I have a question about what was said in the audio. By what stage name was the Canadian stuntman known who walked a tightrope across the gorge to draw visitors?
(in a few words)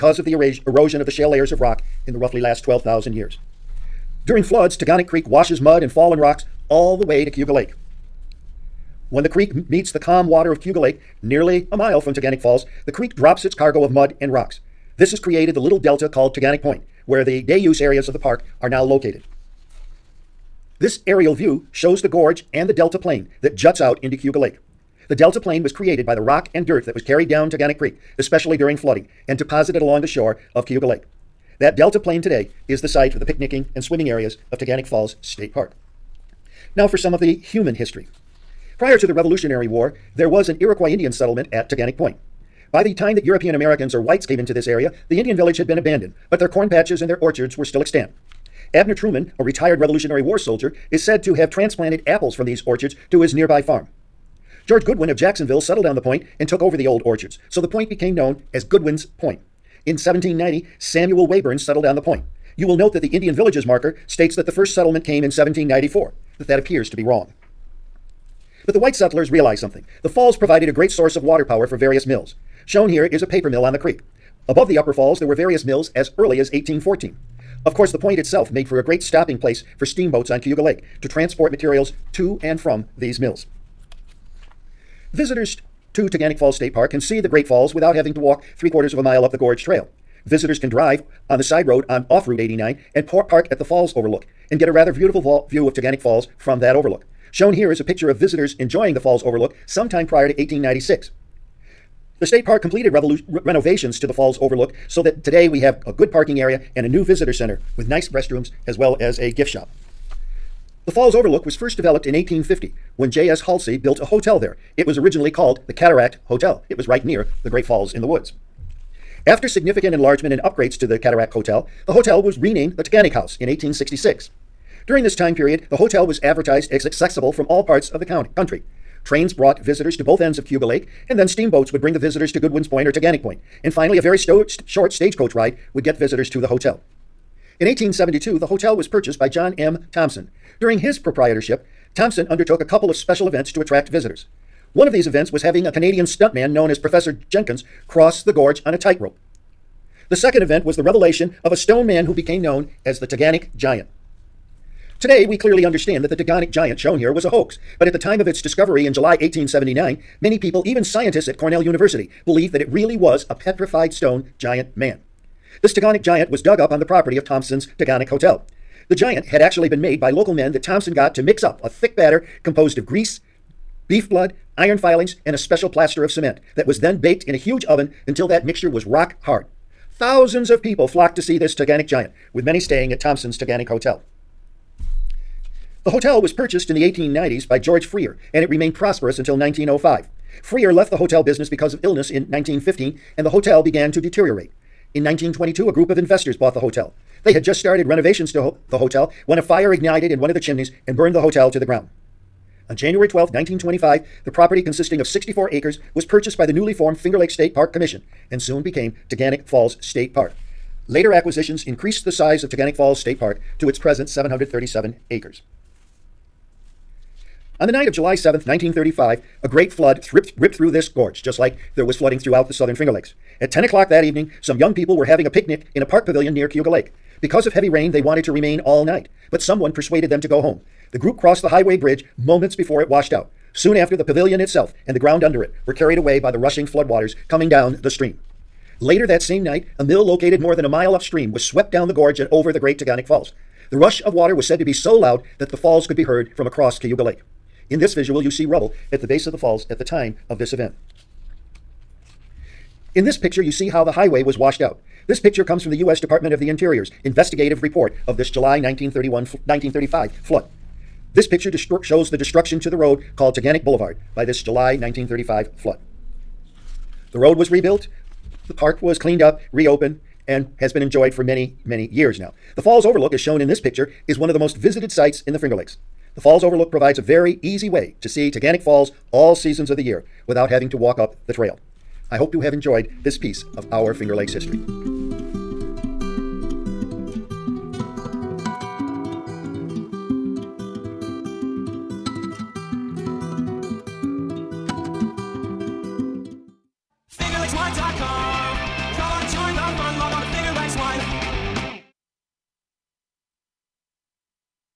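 Professor Jenkins.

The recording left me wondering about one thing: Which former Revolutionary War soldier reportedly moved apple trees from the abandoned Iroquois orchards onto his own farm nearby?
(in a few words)
Abner Truman.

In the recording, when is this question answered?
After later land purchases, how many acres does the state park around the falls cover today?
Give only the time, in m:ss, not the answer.
3:34.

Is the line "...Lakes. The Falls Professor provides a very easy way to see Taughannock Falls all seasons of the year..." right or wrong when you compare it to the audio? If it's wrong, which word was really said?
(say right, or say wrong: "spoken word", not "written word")
wrong: "Overlook", not "Professor".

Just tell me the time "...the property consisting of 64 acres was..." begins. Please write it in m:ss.
3:24.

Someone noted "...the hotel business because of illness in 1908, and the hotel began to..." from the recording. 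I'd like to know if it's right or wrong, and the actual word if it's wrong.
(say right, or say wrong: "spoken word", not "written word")
wrong: "1915", not "1908".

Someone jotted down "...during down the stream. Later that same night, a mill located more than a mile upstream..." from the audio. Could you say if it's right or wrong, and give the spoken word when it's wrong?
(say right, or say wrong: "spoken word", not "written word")
wrong: "coming", not "during".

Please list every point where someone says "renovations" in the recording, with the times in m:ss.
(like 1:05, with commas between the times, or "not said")
1:43, 3:17.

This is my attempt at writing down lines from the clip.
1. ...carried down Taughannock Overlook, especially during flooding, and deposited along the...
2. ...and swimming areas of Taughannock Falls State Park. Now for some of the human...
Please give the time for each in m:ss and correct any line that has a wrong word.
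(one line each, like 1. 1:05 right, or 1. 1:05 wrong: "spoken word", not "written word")
1. 0:27 wrong: "Creek", not "Overlook"
2. 0:33 right.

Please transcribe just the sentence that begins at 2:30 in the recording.
The second event was the revelation of a stone man who became known as the Taughannock Giant.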